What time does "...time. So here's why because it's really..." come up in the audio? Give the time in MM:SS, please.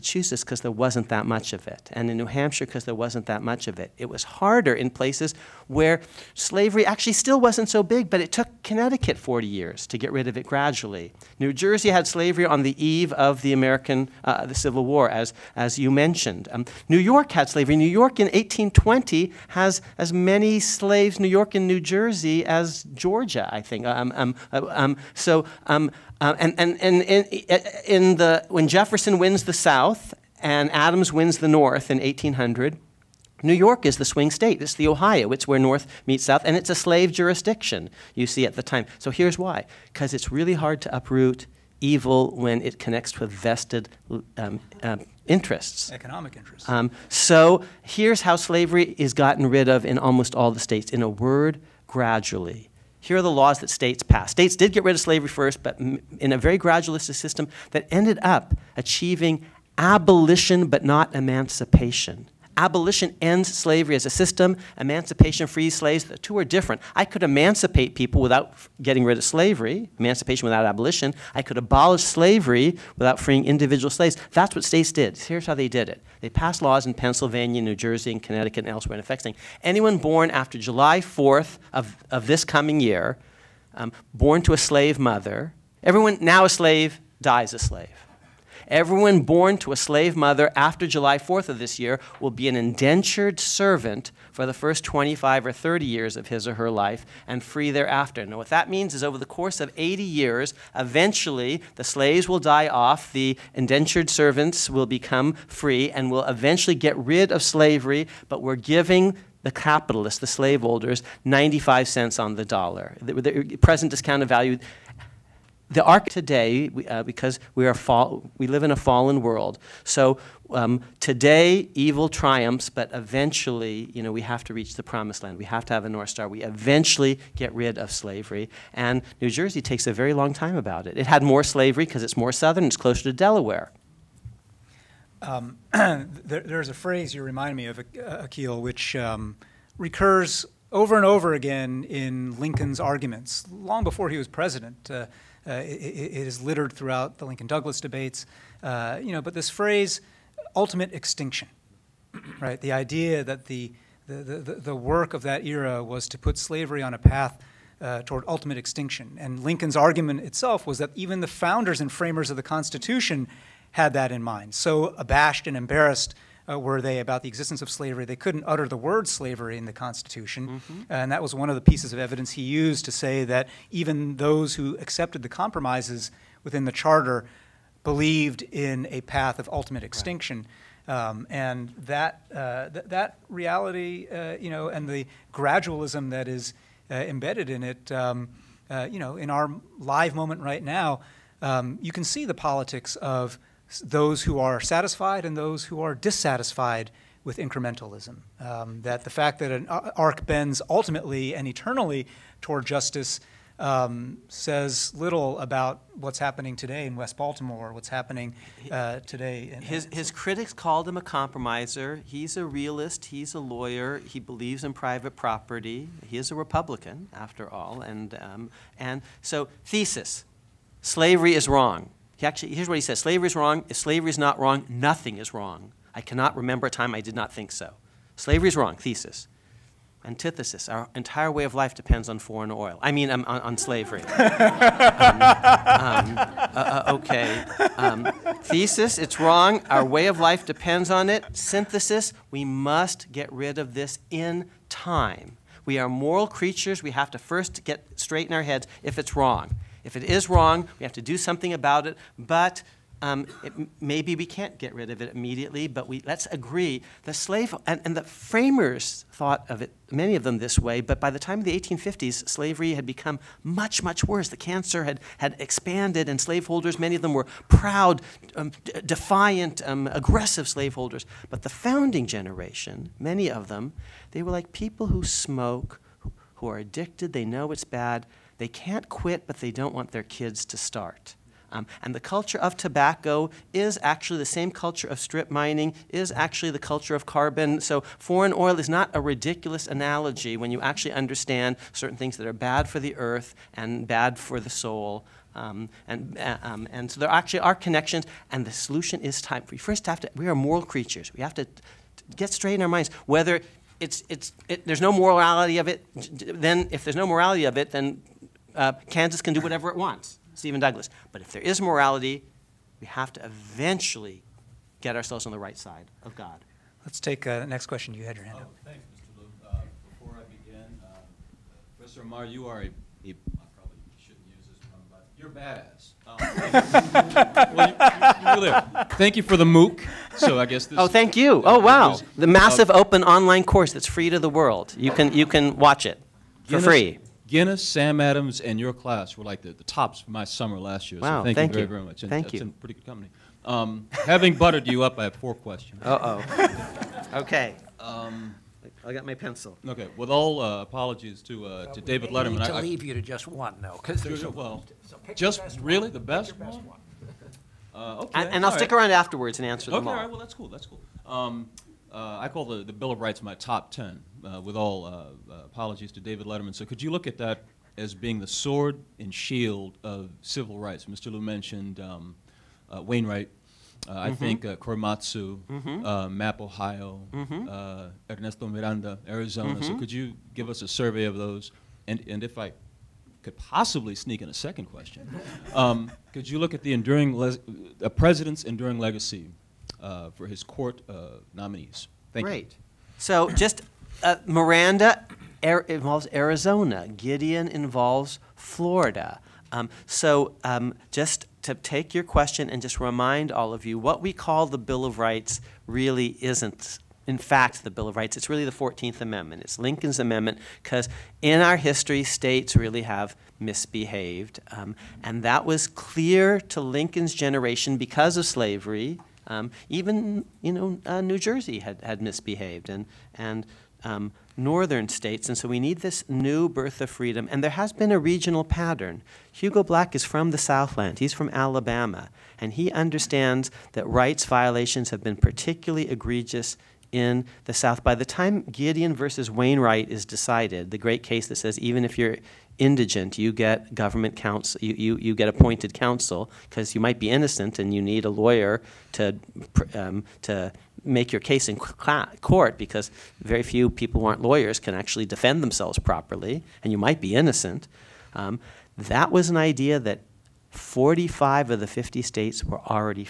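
00:38.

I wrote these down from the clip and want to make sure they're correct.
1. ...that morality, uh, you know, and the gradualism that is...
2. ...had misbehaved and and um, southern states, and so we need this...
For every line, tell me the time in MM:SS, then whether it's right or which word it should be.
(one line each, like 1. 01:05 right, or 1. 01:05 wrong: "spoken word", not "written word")
1. 03:02 wrong: "reality", not "morality"
2. 07:01 wrong: "northern", not "southern".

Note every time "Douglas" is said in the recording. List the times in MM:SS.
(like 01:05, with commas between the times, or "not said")
02:27, 05:10.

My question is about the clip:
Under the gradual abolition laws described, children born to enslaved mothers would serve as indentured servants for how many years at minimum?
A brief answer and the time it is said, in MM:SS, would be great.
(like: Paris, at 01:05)
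25, at 01:34.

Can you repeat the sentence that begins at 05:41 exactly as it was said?
Wow, so thank, thank you, you very, very much.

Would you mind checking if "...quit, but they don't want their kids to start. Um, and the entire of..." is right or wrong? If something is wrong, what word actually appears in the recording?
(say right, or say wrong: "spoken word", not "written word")
wrong: "culture", not "entire".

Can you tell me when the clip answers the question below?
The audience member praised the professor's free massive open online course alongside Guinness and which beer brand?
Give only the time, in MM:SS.
05:37.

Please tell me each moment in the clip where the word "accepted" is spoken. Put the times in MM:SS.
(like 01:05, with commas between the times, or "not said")
02:54.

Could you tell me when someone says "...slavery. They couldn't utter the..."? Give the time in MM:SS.
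02:47.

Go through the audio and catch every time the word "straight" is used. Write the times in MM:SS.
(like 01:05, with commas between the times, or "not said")
04:07, 05:02.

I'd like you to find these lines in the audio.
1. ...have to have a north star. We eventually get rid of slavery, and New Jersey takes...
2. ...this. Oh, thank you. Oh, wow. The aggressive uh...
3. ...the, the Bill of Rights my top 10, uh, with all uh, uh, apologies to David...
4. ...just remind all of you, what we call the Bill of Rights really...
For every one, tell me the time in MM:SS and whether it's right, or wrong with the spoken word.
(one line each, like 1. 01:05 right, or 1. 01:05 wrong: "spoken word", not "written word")
1. 02:05 right
2. 05:30 wrong: "massive", not "aggressive"
3. 06:02 right
4. 06:42 right.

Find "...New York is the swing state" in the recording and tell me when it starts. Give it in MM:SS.
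00:33.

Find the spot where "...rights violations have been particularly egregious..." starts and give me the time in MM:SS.
07:13.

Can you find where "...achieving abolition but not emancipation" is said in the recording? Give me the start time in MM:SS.
00:58.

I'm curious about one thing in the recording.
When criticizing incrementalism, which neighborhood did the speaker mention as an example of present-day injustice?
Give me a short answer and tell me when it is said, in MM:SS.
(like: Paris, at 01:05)
West Baltimore, at 03:26.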